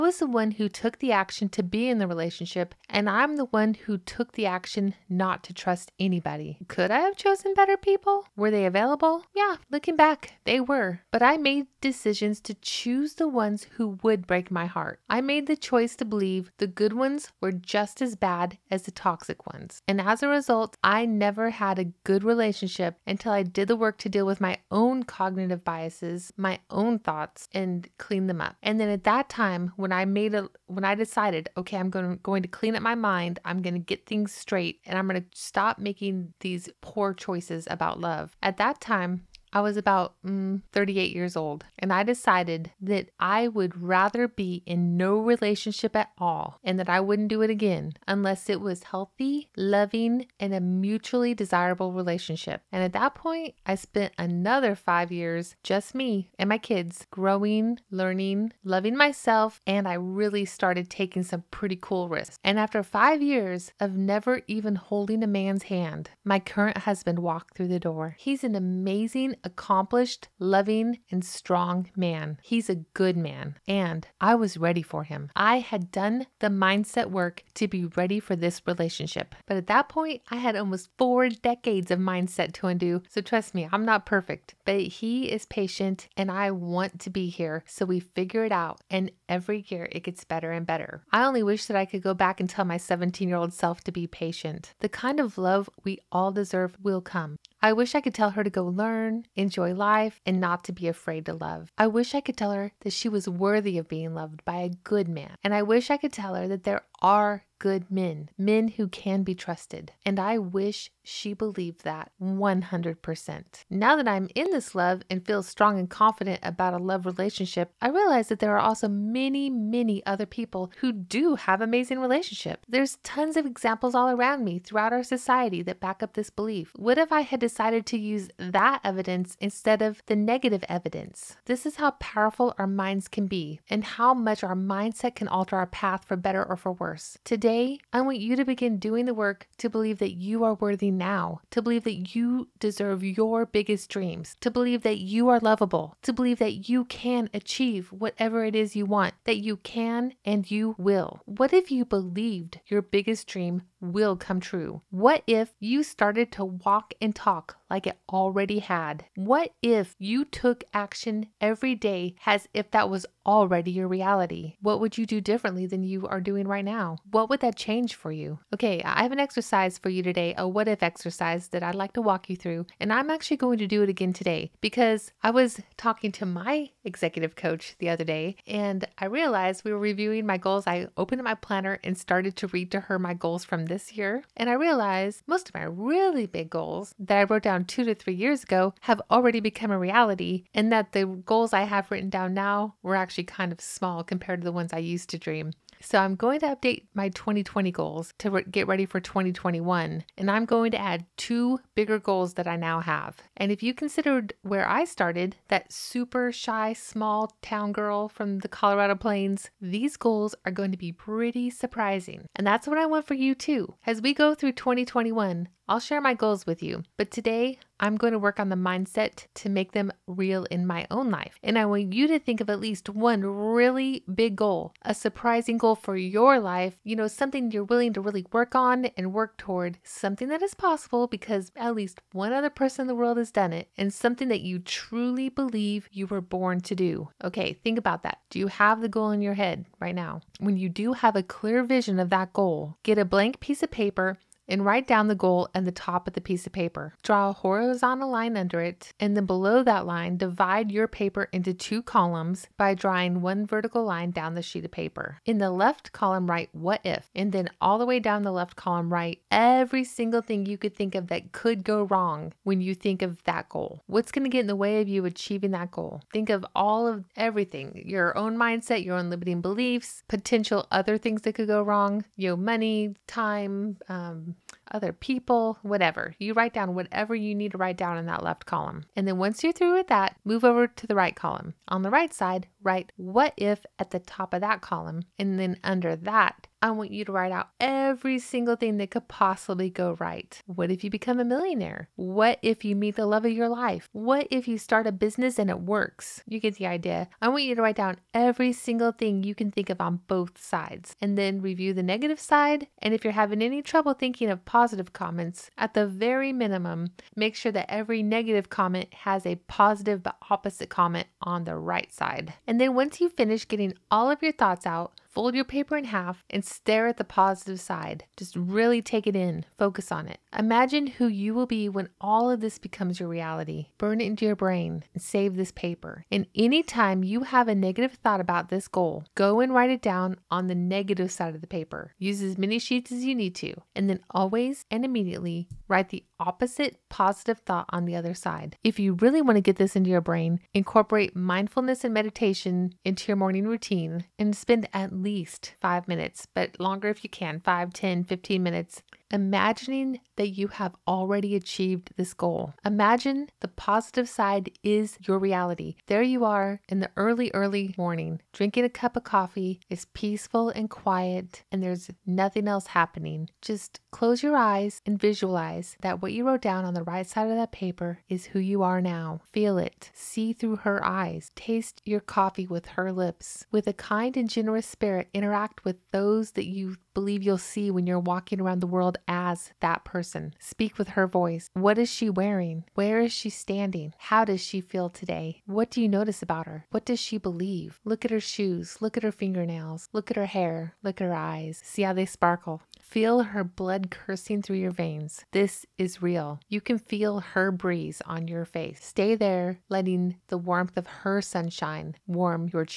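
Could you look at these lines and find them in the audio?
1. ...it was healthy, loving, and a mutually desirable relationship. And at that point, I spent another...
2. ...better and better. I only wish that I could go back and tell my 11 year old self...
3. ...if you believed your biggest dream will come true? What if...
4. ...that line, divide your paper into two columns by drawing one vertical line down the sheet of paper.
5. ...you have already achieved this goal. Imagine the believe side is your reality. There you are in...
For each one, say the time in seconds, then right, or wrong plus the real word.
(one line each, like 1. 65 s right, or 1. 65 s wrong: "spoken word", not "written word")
1. 48 s right
2. 90 s wrong: "17", not "11"
3. 151 s right
4. 249 s right
5. 350 s wrong: "positive", not "believe".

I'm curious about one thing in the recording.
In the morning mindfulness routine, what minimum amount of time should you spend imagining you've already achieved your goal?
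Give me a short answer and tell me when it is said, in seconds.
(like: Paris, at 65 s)
5 minutes, at 345 s.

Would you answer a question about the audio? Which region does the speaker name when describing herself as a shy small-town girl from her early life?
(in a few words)
Colorado Plains.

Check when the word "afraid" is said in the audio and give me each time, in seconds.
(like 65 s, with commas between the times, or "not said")
100 s.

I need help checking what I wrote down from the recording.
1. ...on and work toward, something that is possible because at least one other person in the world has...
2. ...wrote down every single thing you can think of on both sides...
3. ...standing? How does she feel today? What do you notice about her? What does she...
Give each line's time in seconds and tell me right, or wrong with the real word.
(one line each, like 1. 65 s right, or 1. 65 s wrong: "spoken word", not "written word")
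1. 228 s right
2. 297 s wrong: "write", not "wrote"
3. 383 s right.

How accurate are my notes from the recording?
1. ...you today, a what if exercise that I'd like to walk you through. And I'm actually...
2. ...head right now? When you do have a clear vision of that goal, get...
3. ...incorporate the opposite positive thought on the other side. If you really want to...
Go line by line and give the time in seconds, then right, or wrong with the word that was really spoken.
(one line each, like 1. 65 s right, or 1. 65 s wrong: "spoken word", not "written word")
1. 169 s right
2. 239 s right
3. 335 s wrong: "write", not "incorporate".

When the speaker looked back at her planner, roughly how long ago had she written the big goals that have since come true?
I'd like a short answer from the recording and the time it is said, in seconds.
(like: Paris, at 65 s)
2 to 3 years ago, at 187 s.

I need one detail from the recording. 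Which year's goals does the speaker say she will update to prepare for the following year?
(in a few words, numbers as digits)
2020.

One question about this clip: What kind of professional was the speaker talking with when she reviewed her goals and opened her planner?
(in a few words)
Executive coach.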